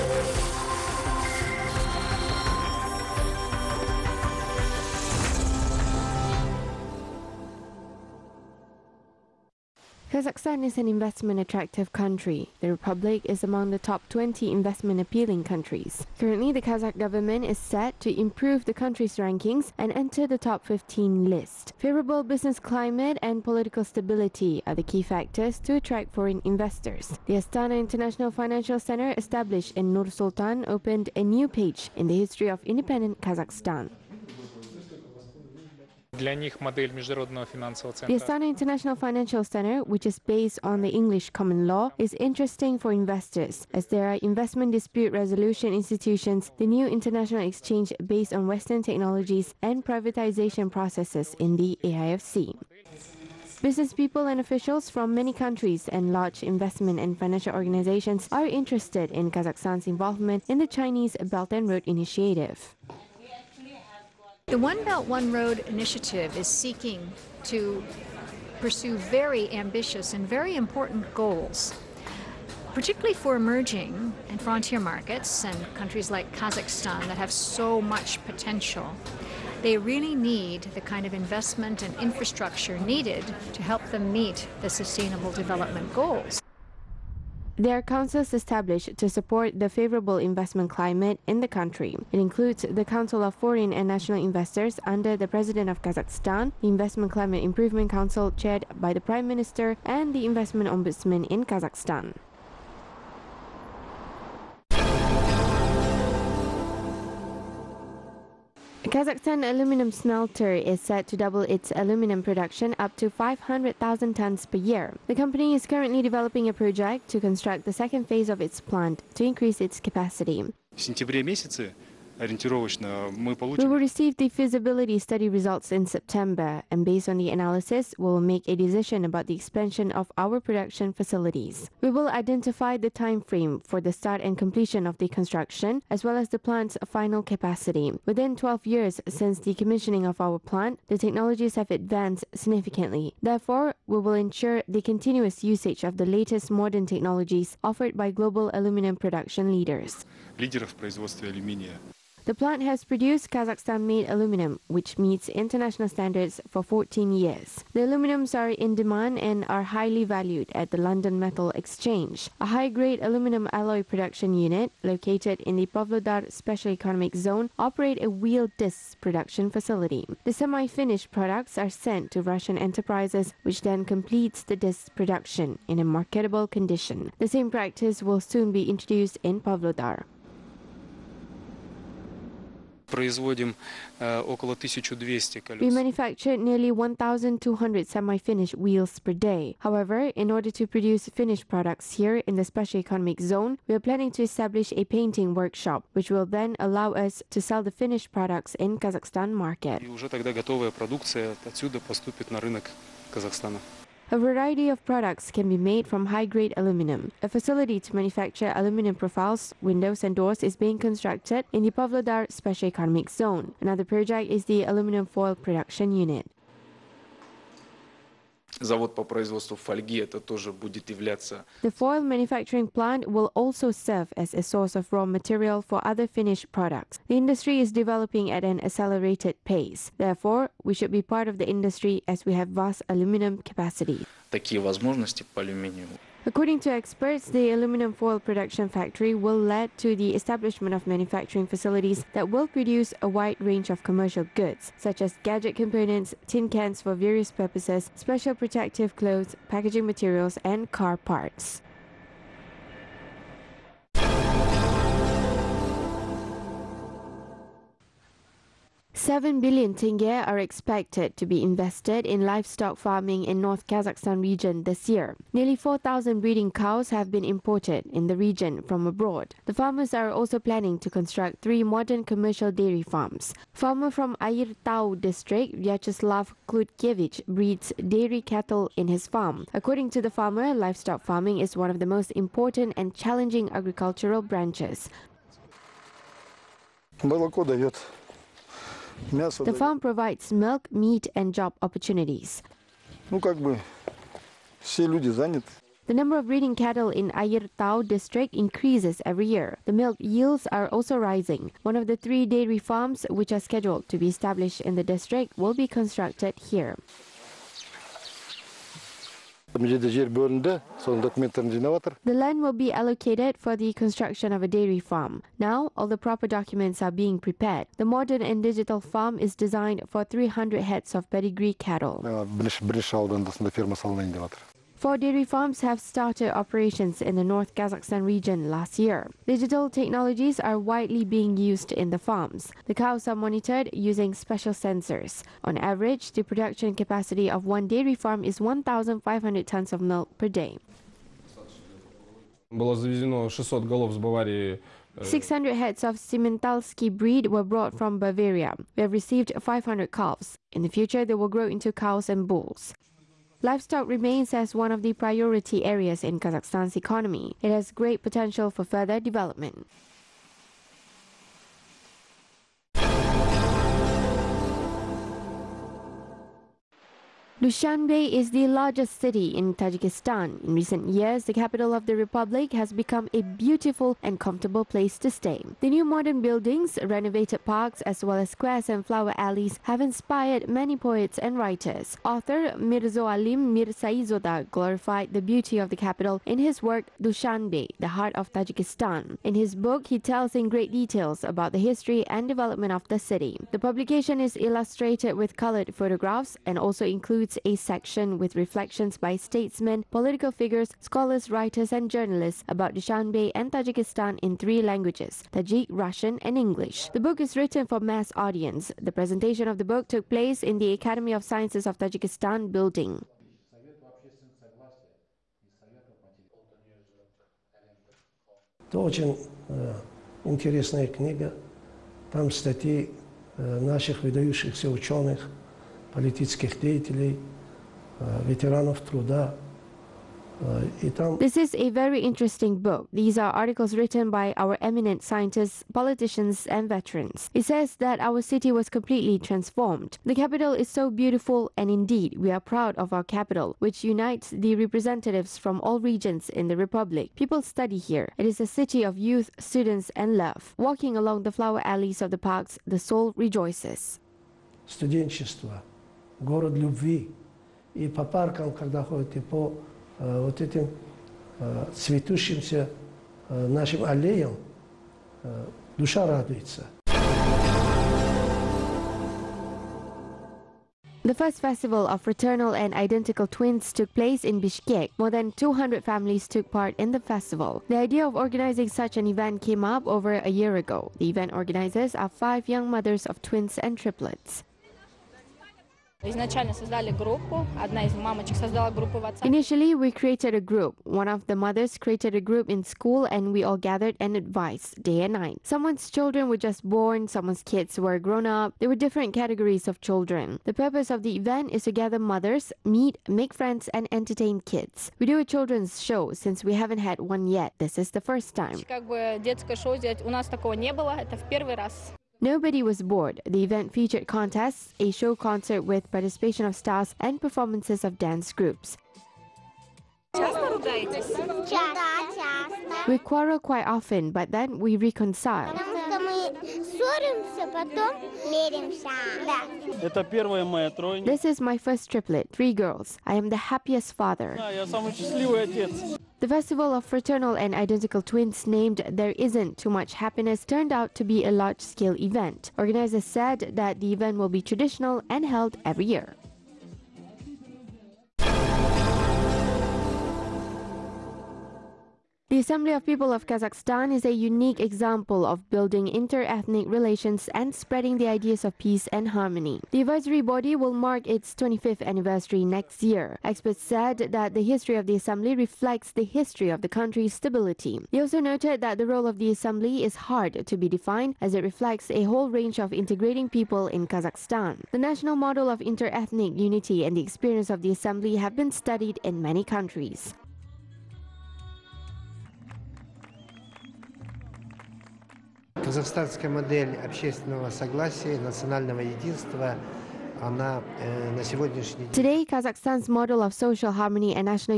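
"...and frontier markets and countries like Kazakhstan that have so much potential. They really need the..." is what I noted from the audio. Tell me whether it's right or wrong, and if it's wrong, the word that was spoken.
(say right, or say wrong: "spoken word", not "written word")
right.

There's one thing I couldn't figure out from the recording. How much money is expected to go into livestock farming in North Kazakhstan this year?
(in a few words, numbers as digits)
7 billion tenge.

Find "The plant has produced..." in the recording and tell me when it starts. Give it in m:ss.
2:32.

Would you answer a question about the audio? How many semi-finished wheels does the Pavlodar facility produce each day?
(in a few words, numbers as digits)
1,200.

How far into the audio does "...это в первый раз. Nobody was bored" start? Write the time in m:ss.
8:30.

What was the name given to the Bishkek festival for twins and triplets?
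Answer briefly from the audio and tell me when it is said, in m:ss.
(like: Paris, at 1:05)
There Isn't Too Much Happiness, at 8:58.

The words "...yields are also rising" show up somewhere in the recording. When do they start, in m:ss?
5:00.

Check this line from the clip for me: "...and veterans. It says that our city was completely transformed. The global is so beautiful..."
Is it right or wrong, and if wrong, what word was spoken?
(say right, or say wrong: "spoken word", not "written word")
wrong: "capital", not "global".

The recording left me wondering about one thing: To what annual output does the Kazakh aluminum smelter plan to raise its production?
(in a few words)
500,000 tons.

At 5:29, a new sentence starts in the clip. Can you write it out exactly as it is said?
Digital technologies are widely being used in the farms.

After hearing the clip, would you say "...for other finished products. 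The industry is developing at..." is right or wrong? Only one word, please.
right.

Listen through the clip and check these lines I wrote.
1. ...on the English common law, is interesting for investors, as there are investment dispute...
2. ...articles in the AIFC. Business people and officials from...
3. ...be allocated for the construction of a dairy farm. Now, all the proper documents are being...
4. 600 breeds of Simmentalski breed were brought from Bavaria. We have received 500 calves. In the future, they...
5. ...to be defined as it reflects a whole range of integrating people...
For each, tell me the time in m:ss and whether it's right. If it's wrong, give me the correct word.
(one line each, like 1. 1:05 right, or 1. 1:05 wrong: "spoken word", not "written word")
1. 0:40 right
2. 0:50 wrong: "processes", not "articles"
3. 5:12 right
4. 5:42 wrong: "heads", not "breeds"
5. 9:30 right.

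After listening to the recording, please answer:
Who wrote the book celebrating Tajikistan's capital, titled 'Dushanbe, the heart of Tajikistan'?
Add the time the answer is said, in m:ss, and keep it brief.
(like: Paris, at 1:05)
Mirzo Alim Mirzaizoda, at 6:22.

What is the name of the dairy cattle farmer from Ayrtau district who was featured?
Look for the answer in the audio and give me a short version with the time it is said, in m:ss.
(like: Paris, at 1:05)
Vyacheslav Klutkevich, at 4:35.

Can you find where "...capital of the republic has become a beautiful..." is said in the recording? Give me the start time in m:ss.
6:11.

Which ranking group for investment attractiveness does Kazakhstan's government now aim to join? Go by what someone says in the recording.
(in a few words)
top 15.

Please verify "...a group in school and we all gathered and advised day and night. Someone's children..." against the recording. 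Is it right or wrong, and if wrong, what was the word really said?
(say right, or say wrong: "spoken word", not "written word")
right.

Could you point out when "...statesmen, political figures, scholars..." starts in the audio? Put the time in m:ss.
6:39.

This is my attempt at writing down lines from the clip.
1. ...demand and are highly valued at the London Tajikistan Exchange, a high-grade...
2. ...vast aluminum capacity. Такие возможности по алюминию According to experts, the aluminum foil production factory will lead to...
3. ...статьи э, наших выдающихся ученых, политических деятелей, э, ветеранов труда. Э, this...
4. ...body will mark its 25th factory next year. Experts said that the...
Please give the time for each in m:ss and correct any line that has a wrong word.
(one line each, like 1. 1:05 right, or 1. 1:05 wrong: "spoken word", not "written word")
1. 2:38 wrong: "Metal", not "Tajikistan"
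2. 3:52 right
3. 7:02 right
4. 9:20 wrong: "anniversary", not "factory".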